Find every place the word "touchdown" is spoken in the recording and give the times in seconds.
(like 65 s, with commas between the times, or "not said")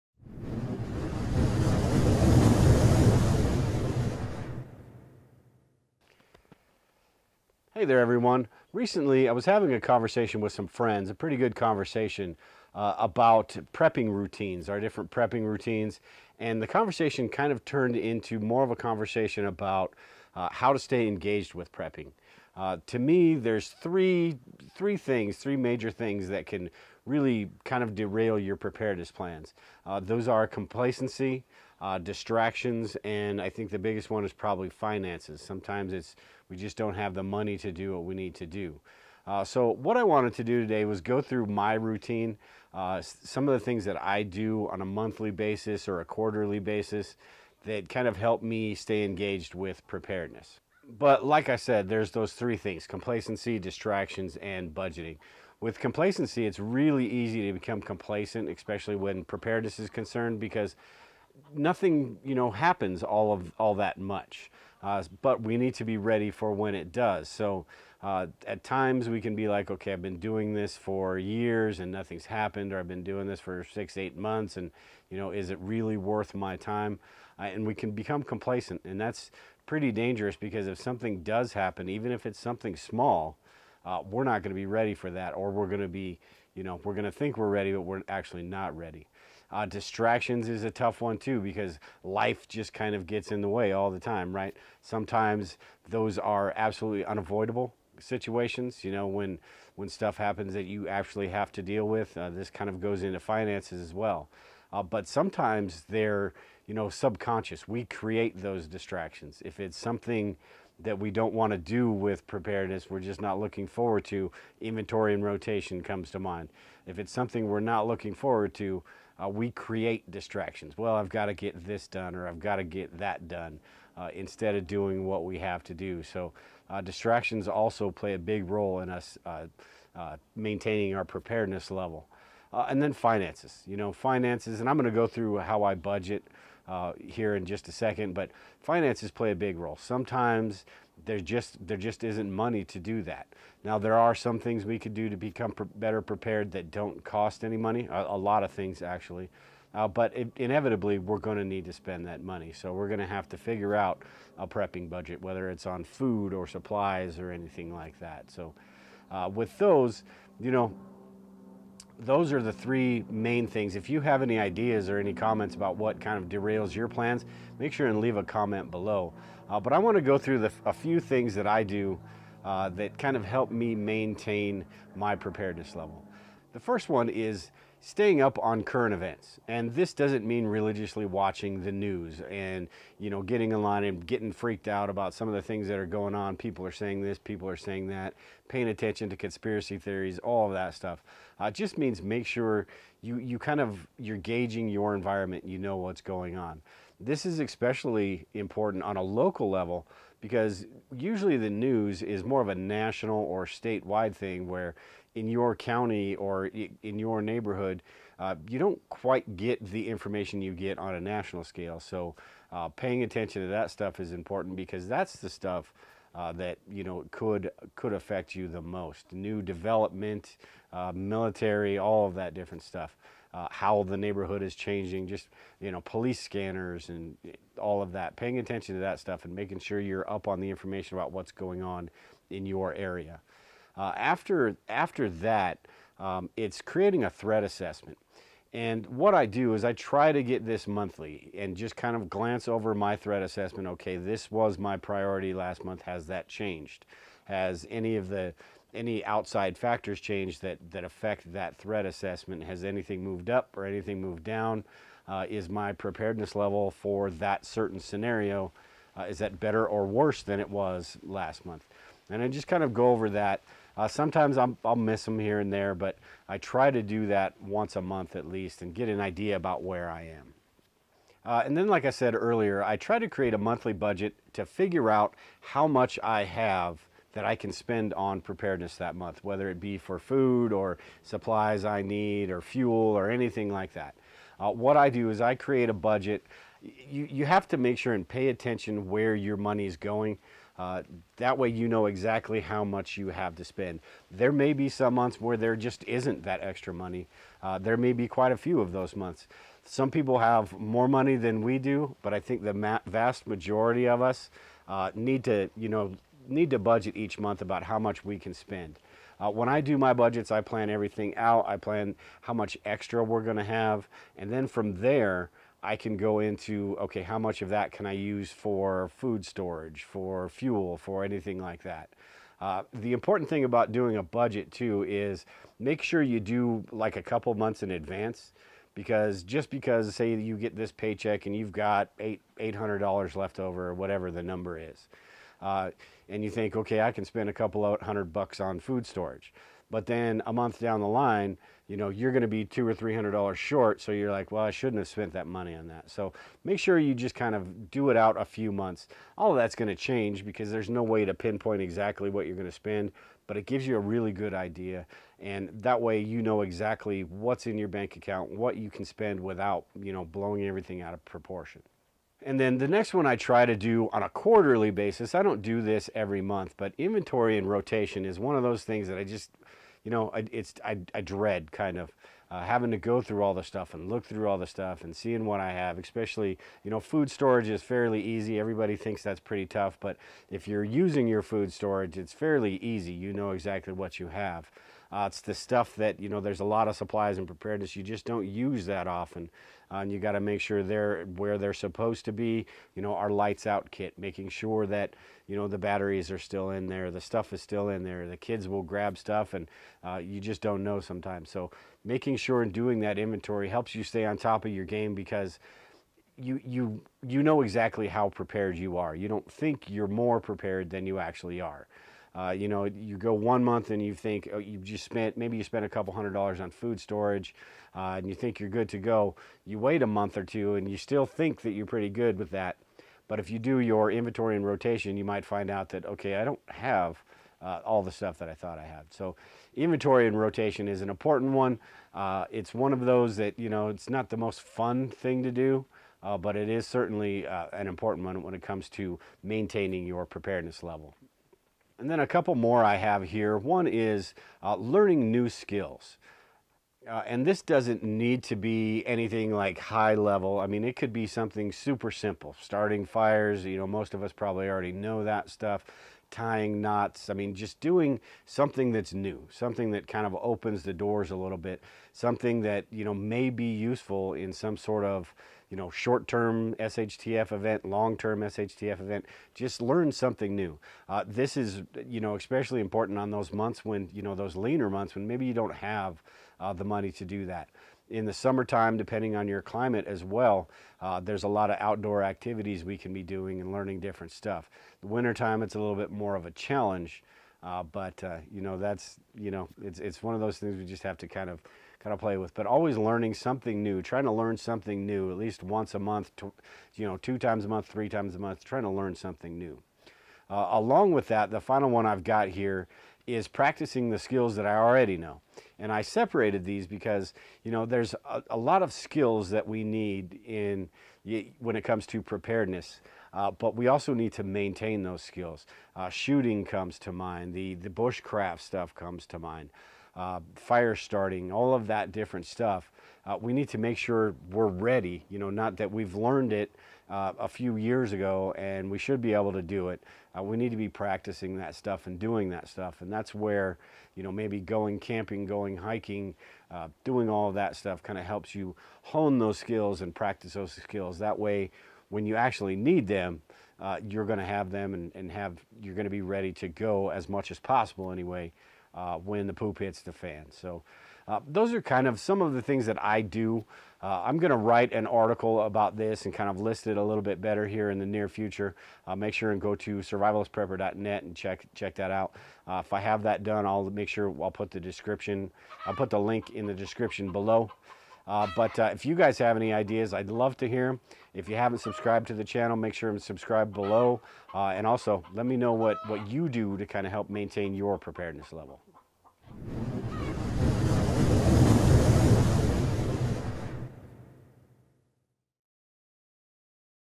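not said.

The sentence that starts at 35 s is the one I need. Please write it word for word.
Sometimes it's we just don't have the money to do what we need to do.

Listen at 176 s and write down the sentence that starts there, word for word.
The first one is staying up on current events.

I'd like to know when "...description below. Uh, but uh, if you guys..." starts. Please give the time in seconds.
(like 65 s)
566 s.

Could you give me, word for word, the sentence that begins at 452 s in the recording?
Starting fires, you know, most of us probably already know that stuff tying knots.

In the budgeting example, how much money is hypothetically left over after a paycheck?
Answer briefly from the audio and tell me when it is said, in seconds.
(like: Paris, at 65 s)
$800, at 332 s.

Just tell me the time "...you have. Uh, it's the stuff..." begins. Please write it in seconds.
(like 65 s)
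383 s.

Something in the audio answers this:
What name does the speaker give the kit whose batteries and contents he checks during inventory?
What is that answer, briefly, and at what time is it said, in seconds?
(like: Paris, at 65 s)
lights out kit, at 392 s.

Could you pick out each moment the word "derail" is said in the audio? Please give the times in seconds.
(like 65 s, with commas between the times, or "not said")
27 s, 166 s.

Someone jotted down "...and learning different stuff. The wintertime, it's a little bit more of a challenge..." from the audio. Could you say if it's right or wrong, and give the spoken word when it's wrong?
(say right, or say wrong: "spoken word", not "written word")
right.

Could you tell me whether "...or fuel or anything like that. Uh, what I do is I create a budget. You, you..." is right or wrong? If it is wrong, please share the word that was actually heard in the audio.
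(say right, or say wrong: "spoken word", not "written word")
right.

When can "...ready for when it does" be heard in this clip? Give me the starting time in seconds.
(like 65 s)
65 s.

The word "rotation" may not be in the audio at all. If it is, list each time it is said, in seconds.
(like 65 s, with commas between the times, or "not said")
115 s, 367 s, 424 s, 430 s.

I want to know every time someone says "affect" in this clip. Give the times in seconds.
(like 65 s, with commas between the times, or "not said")
217 s, 250 s.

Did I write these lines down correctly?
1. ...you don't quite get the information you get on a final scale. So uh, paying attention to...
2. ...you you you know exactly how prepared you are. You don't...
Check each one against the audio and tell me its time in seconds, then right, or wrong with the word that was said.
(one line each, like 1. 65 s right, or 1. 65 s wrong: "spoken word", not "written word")
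1. 208 s wrong: "national", not "final"
2. 406 s right.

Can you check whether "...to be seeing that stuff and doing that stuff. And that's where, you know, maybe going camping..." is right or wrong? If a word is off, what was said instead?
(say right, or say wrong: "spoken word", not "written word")
wrong: "practicing", not "seeing".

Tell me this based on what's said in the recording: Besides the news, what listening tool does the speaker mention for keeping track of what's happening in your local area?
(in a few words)
police scanners.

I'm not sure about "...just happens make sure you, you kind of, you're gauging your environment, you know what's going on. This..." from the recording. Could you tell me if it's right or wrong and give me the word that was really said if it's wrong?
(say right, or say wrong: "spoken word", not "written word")
wrong: "means", not "happens".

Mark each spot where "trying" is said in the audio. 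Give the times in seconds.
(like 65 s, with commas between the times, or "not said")
493 s, 498 s.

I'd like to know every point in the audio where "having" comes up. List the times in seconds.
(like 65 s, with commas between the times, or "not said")
9 s, 372 s.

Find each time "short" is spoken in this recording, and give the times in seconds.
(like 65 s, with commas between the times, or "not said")
343 s, 465 s.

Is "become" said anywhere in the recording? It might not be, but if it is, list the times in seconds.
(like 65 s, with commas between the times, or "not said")
57 s, 77 s, 145 s.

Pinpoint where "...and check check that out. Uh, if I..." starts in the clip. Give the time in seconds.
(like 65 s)
561 s.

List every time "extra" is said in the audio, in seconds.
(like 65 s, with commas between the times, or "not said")
296 s, 312 s.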